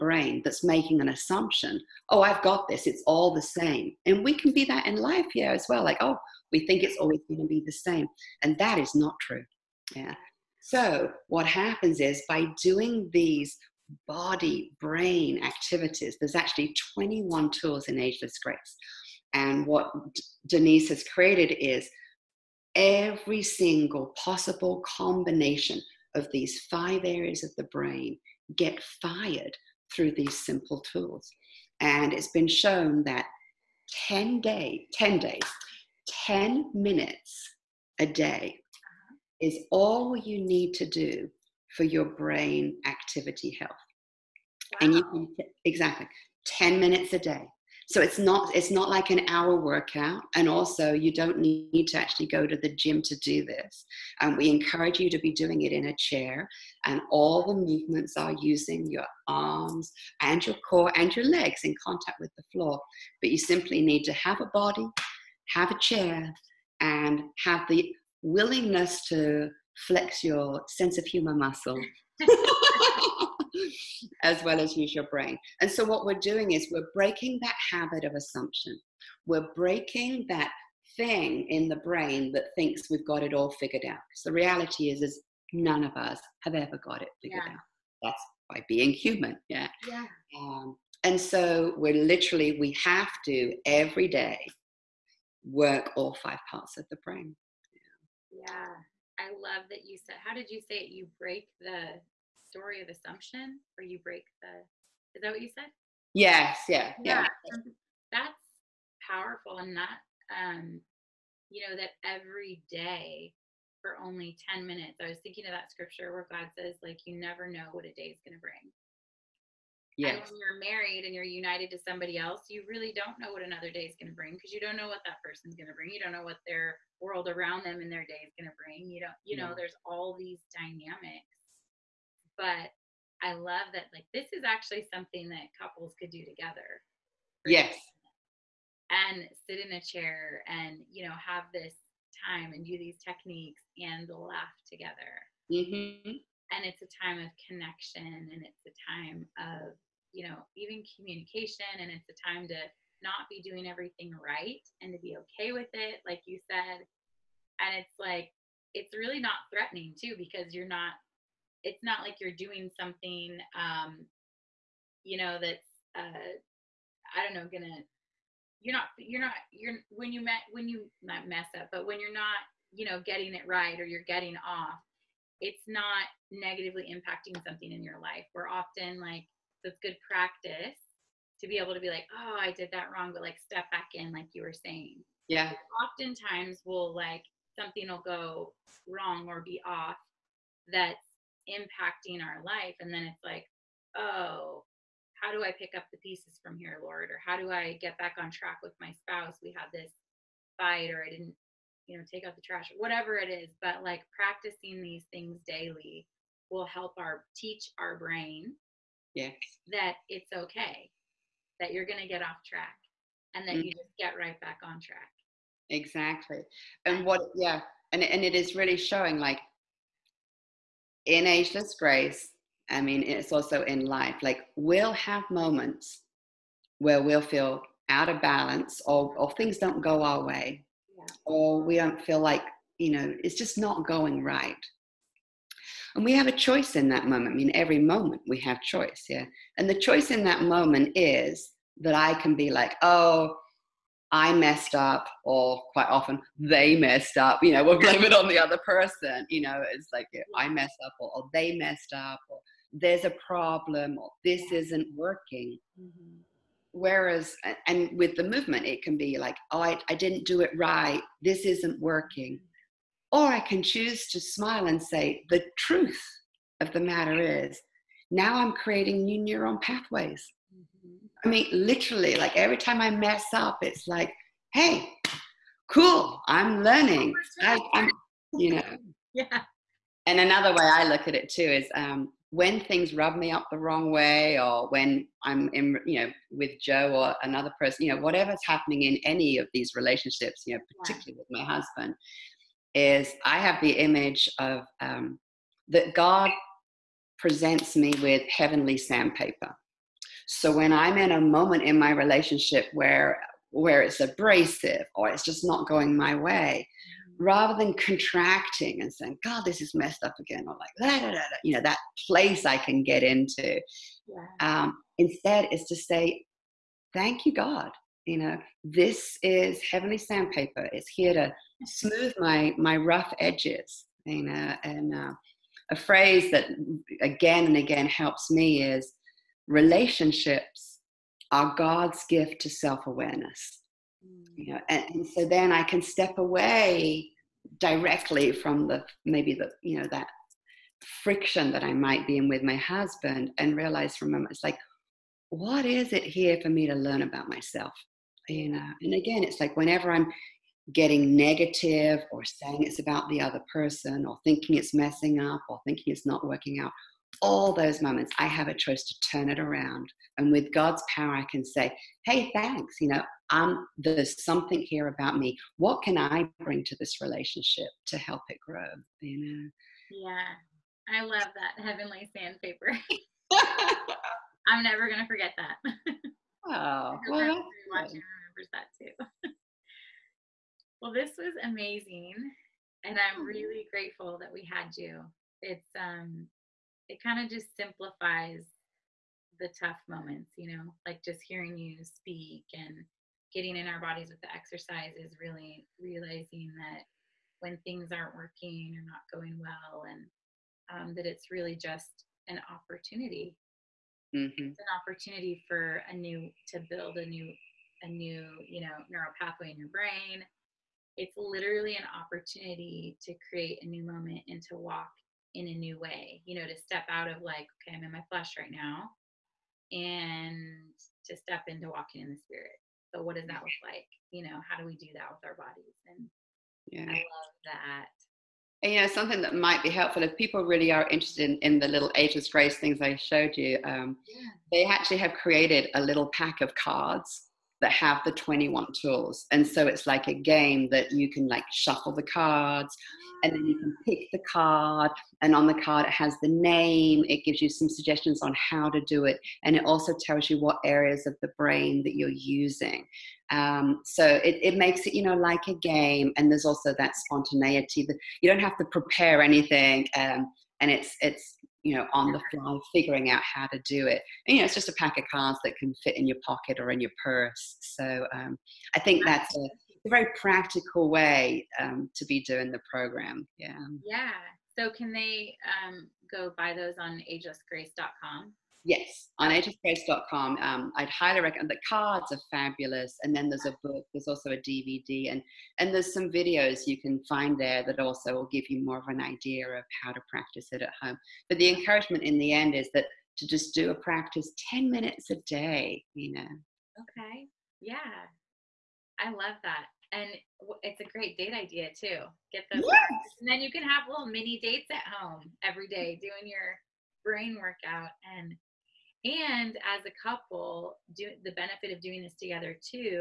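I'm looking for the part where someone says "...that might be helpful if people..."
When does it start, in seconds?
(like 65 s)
429 s.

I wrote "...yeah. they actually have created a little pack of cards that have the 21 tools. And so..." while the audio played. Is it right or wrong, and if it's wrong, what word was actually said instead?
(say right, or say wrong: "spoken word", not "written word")
right.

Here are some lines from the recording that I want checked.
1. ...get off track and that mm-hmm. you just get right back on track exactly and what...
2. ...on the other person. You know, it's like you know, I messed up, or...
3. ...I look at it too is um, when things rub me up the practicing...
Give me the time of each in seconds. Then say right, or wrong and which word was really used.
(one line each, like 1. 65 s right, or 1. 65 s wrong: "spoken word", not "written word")
1. 212 s right
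2. 248 s right
3. 280 s wrong: "wrong", not "practicing".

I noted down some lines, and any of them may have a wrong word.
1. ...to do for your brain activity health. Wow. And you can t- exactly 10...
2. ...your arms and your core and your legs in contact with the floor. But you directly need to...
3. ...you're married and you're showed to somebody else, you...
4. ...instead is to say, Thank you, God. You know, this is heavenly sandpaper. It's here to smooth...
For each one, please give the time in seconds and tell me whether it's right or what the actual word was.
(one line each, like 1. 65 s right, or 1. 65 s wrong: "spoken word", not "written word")
1. 40 s right
2. 58 s wrong: "simply", not "directly"
3. 120 s wrong: "united", not "showed"
4. 314 s right.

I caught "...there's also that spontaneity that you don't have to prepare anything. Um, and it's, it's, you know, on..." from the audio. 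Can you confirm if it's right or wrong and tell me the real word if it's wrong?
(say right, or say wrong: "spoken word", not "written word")
right.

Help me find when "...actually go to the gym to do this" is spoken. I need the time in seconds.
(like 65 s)
51 s.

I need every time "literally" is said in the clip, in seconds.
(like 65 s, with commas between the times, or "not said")
92 s, 271 s, 411 s.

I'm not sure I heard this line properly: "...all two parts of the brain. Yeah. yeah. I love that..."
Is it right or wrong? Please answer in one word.
wrong.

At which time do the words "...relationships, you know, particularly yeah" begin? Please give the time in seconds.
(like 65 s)
289 s.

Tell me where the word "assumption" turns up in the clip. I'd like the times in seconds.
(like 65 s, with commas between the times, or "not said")
1 s, 78 s, 102 s.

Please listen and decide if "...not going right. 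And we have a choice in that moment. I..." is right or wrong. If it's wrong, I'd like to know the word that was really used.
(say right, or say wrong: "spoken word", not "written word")
right.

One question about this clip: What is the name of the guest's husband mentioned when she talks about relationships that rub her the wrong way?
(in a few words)
Joe.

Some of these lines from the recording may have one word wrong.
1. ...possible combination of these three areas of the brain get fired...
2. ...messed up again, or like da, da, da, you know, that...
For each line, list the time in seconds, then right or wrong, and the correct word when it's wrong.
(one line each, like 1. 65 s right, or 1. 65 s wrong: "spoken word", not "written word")
1. 24 s wrong: "five", not "three"
2. 309 s right.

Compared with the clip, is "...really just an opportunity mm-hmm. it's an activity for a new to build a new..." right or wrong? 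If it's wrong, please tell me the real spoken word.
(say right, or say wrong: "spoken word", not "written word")
wrong: "opportunity", not "activity".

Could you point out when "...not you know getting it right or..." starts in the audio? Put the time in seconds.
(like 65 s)
172 s.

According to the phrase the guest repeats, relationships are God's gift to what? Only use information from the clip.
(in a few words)
self awareness.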